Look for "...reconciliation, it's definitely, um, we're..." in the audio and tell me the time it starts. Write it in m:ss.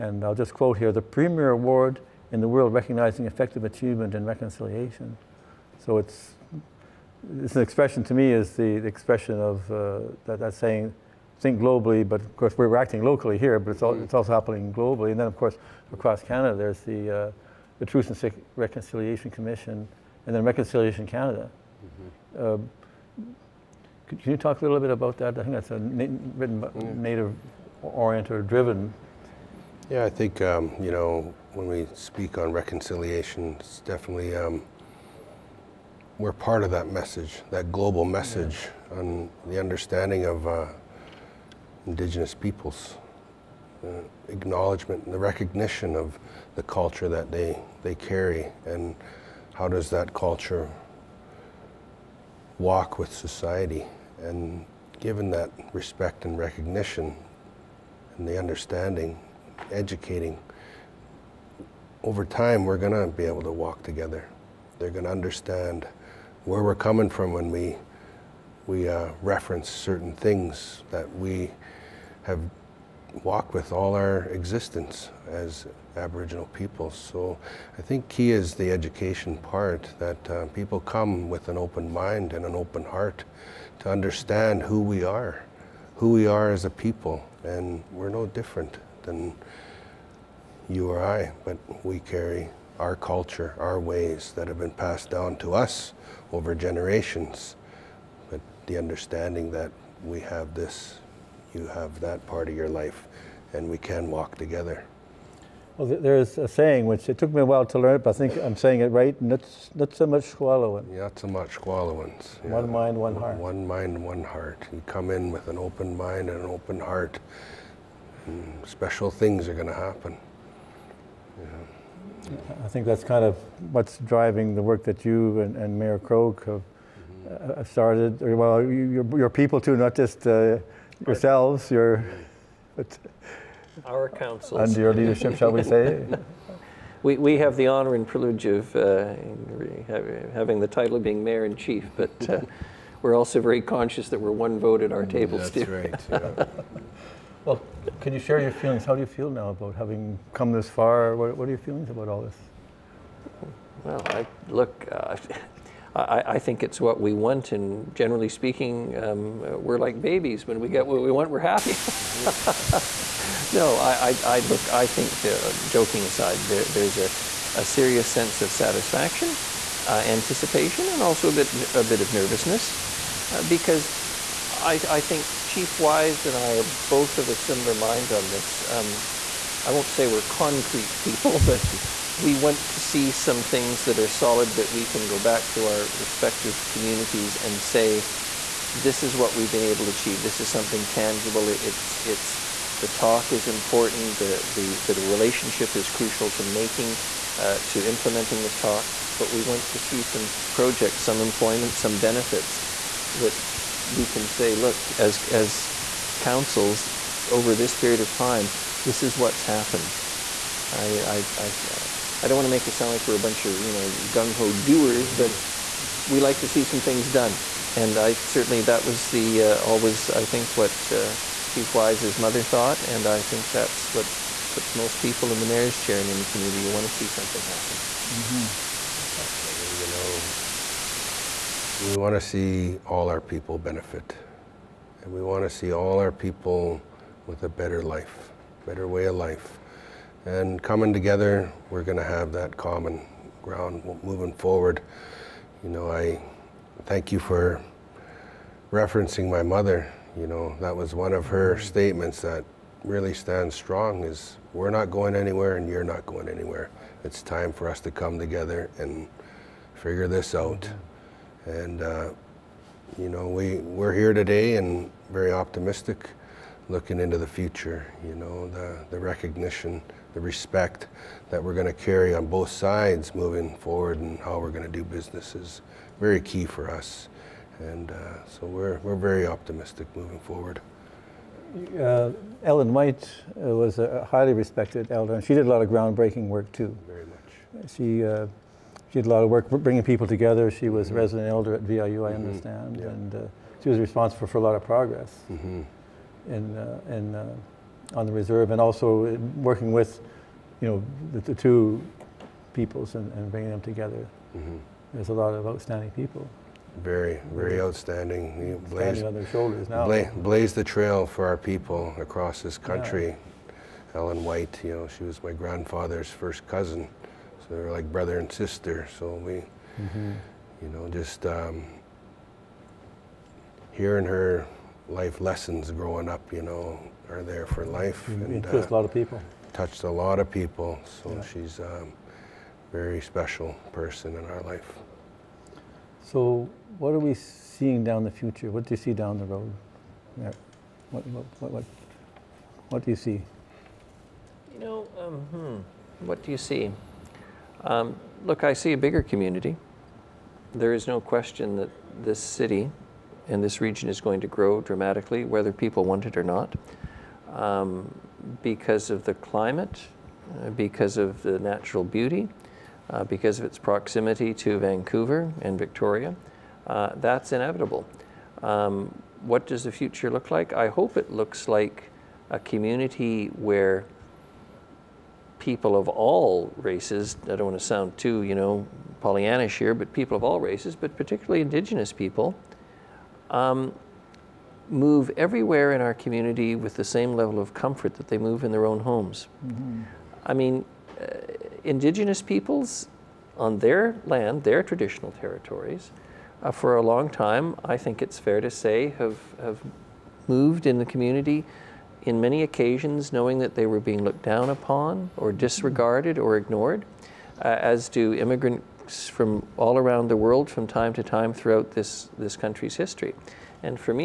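0:32.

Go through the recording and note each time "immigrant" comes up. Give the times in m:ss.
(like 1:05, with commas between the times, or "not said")
6:48.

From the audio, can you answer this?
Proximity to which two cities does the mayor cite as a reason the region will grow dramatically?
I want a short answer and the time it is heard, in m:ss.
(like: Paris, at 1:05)
Vancouver and Victoria, at 6:04.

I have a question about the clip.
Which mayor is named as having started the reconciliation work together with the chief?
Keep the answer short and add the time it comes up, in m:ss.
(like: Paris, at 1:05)
Krog, at 2:05.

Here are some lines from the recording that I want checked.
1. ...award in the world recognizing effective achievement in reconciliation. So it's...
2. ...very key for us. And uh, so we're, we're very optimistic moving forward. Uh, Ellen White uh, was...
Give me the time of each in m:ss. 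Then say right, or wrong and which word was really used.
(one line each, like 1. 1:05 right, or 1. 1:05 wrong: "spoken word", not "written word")
1. 0:01 right
2. 4:35 right.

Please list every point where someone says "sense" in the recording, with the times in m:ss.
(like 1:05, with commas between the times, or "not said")
2:48.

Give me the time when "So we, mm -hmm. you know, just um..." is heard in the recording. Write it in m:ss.
5:18.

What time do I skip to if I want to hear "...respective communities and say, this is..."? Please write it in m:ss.
3:05.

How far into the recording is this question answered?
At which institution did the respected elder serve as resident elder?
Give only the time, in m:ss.
4:51.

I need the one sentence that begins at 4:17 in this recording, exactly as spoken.
It's time for us to come together and figure this out.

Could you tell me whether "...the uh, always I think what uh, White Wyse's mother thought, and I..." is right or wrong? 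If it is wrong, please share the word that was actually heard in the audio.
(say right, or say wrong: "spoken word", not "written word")
wrong: "Chief", not "White".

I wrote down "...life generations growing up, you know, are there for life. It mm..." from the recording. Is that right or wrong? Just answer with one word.
wrong.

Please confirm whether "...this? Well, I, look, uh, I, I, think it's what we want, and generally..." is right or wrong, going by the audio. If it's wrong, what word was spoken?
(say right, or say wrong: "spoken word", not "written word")
right.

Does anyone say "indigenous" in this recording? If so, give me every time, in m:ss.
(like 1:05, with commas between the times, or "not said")
0:41, 6:21, 6:31.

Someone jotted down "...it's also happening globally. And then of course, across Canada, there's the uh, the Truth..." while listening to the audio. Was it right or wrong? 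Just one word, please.
right.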